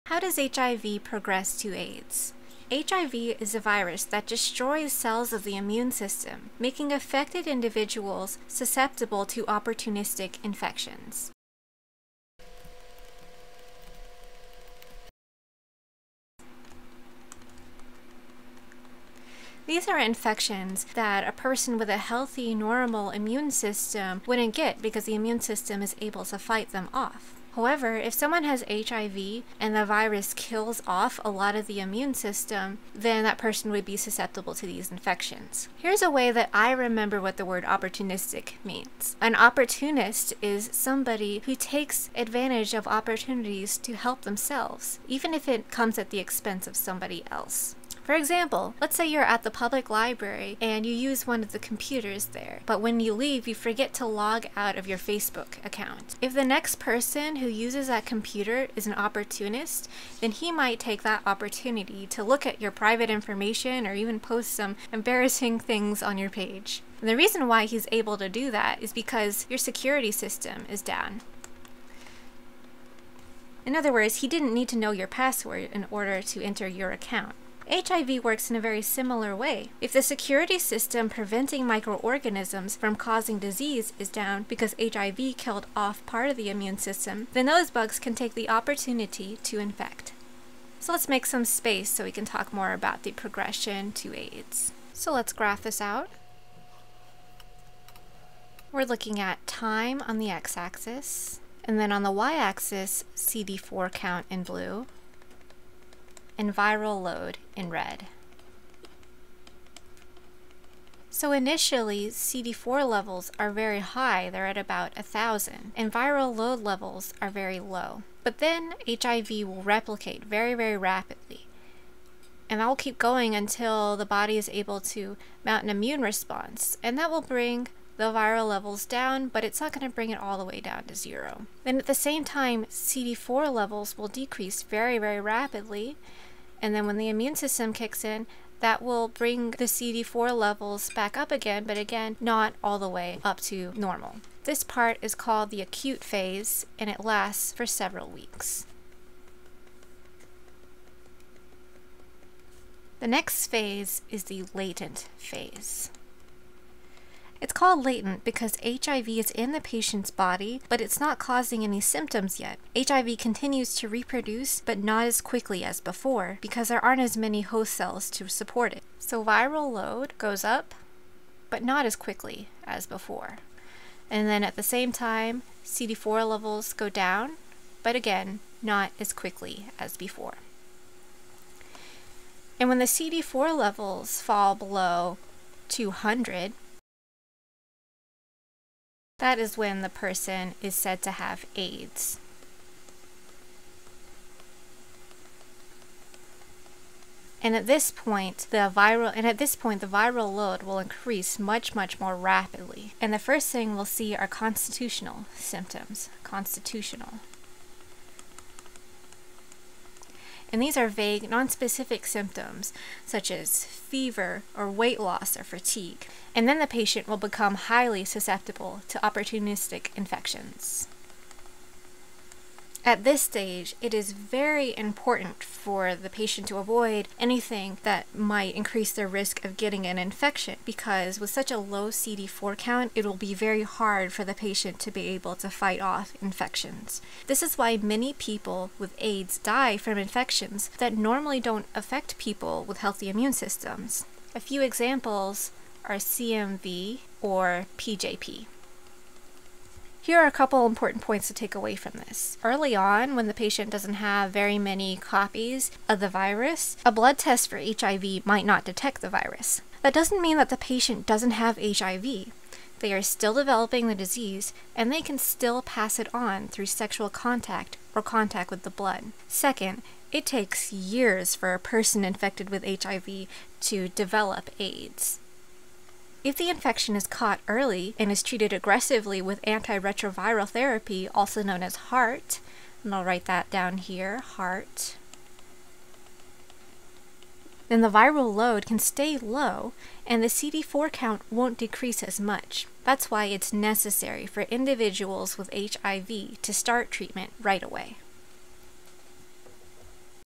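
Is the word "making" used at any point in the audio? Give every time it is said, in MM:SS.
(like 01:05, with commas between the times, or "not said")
00:06.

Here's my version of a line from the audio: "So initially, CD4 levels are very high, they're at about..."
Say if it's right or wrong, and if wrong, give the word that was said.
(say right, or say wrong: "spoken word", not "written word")
right.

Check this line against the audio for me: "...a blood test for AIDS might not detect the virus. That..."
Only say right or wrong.
wrong.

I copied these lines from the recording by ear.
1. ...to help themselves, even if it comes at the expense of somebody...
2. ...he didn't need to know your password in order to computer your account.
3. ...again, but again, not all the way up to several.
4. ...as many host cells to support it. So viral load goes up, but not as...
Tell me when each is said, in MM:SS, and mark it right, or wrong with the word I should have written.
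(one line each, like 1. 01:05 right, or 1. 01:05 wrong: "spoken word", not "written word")
1. 00:43 right
2. 01:14 wrong: "enter", not "computer"
3. 02:21 wrong: "normal", not "several"
4. 02:47 right.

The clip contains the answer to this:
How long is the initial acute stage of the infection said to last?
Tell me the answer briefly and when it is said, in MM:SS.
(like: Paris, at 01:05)
several weeks, at 02:27.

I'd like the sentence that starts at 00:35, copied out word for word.
Here's a way that I remember what the word opportunistic means.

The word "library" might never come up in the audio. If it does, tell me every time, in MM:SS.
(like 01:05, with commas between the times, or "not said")
00:49.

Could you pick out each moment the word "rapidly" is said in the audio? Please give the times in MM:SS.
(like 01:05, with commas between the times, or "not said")
02:00, 02:15, 03:22.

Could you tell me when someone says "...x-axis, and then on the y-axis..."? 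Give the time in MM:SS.
01:40.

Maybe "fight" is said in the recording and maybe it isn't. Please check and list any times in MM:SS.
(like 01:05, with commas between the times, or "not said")
00:26, 03:55.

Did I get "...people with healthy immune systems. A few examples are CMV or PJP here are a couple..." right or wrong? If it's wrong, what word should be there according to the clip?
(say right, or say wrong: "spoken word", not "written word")
right.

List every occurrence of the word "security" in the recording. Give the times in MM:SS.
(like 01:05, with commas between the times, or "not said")
01:09, 01:20.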